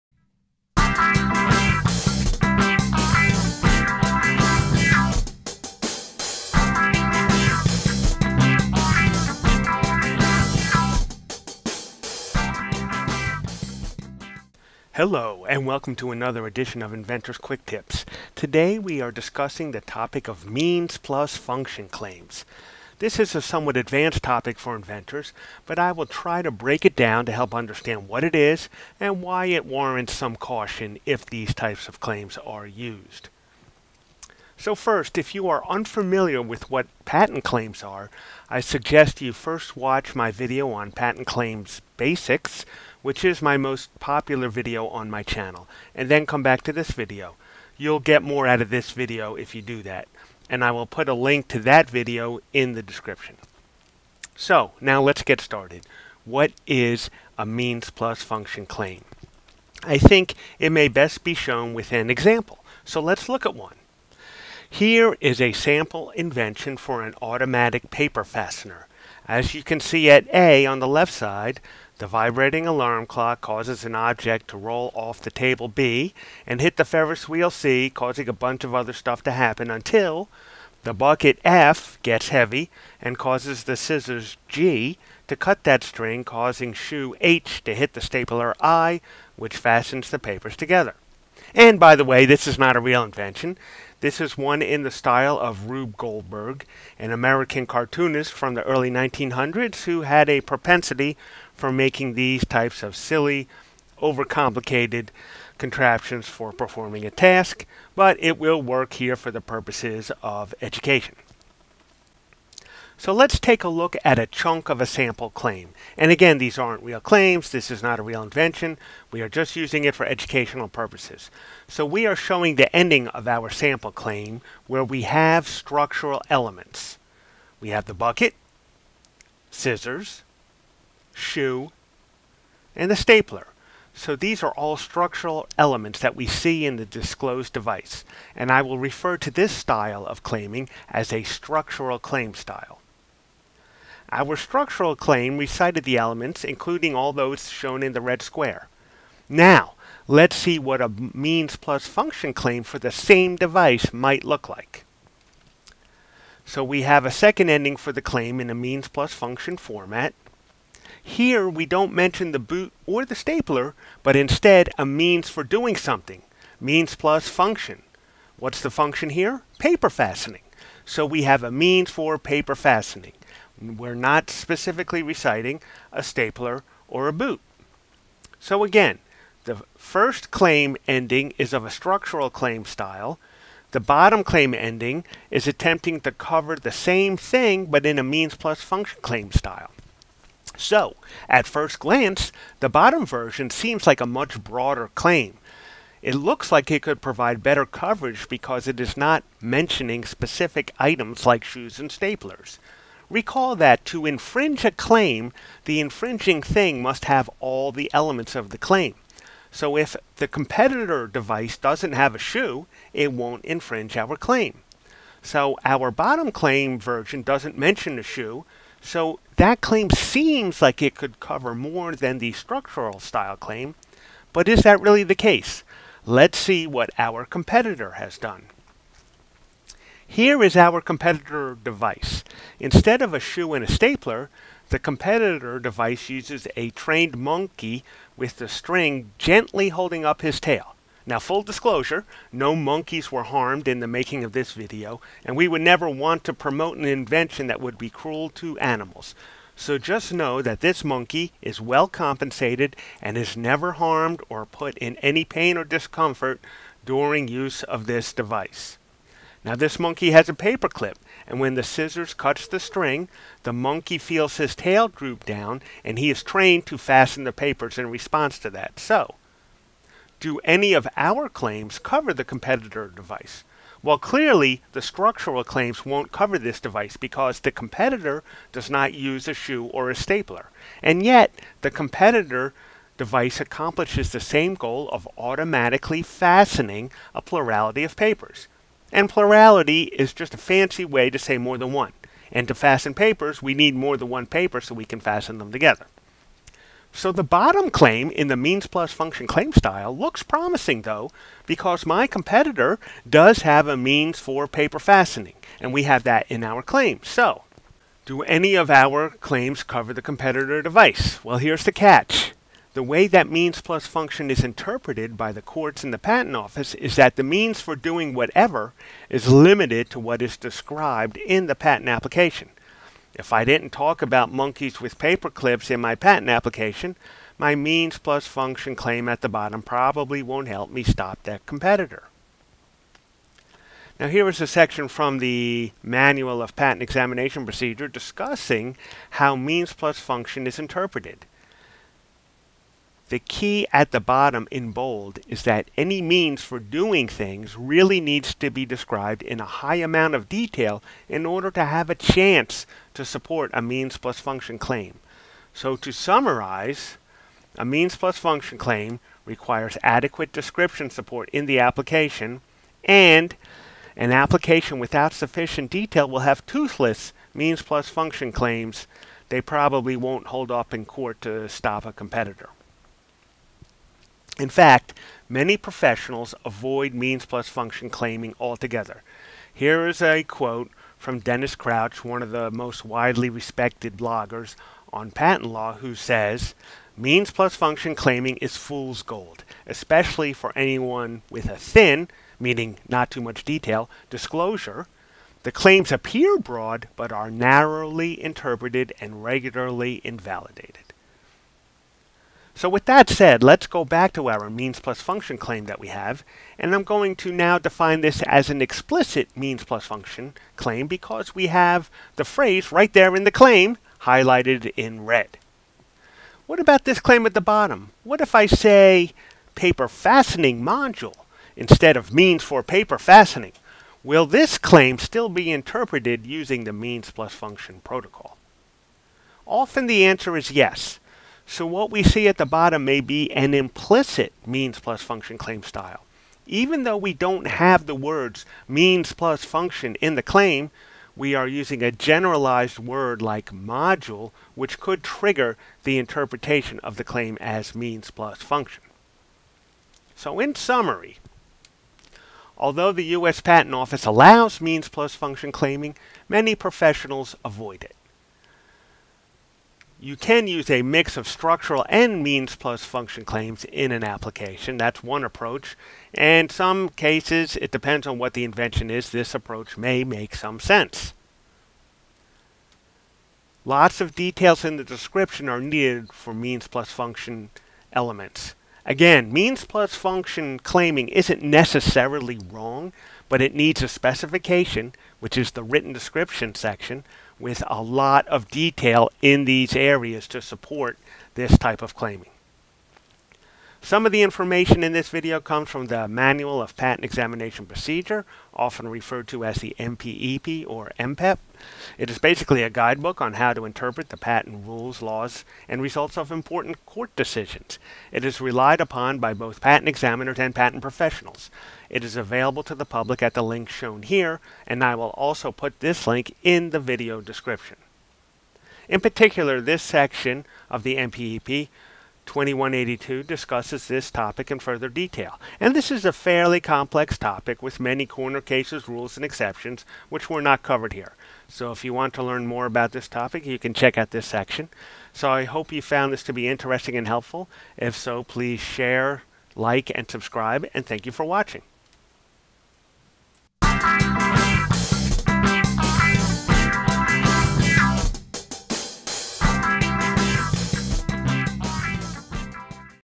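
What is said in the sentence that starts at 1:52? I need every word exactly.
So let's take a look at a chunk of a sample claim.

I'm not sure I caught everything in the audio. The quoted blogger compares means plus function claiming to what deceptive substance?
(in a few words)
fool's gold.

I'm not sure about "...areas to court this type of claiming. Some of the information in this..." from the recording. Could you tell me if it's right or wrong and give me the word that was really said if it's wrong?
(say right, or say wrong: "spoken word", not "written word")
wrong: "support", not "court".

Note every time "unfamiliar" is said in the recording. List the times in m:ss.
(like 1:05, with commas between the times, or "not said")
0:35.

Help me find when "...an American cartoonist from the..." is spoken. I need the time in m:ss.
1:36.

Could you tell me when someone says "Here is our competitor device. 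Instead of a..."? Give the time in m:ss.
3:50.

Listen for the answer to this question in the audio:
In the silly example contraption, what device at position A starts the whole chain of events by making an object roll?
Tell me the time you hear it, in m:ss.
1:12.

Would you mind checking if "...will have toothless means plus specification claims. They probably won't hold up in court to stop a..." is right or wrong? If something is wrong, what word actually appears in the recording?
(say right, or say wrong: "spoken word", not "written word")
wrong: "function", not "specification".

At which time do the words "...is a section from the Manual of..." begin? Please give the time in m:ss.
5:34.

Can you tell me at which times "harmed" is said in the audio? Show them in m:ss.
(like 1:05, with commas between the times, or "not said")
4:03, 4:13.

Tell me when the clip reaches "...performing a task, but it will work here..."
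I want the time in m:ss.
1:46.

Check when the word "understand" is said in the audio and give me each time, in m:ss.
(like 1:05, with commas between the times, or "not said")
0:27.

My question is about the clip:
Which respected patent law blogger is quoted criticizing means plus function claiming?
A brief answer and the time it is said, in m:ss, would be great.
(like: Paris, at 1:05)
Dennis Crouch, at 6:21.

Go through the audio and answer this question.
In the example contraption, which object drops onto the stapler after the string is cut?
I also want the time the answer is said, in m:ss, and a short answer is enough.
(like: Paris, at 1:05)
shoe H, at 1:26.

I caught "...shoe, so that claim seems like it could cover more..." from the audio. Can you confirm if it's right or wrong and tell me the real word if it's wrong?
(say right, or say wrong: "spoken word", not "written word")
right.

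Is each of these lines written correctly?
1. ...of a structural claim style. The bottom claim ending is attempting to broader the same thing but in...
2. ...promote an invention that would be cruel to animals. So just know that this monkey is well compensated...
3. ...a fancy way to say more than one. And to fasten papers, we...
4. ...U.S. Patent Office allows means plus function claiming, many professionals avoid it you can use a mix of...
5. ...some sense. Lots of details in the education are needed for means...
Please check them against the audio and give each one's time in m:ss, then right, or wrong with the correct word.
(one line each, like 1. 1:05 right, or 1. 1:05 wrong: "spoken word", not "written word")
1. 3:01 wrong: "cover", not "broader"
2. 4:06 right
3. 4:50 right
4. 7:33 right
5. 7:50 wrong: "description", not "education".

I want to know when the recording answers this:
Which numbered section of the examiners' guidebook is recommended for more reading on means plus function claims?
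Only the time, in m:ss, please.
8:42.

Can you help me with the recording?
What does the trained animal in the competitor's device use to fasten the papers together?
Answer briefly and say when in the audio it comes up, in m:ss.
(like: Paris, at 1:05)
a paperclip, at 4:20.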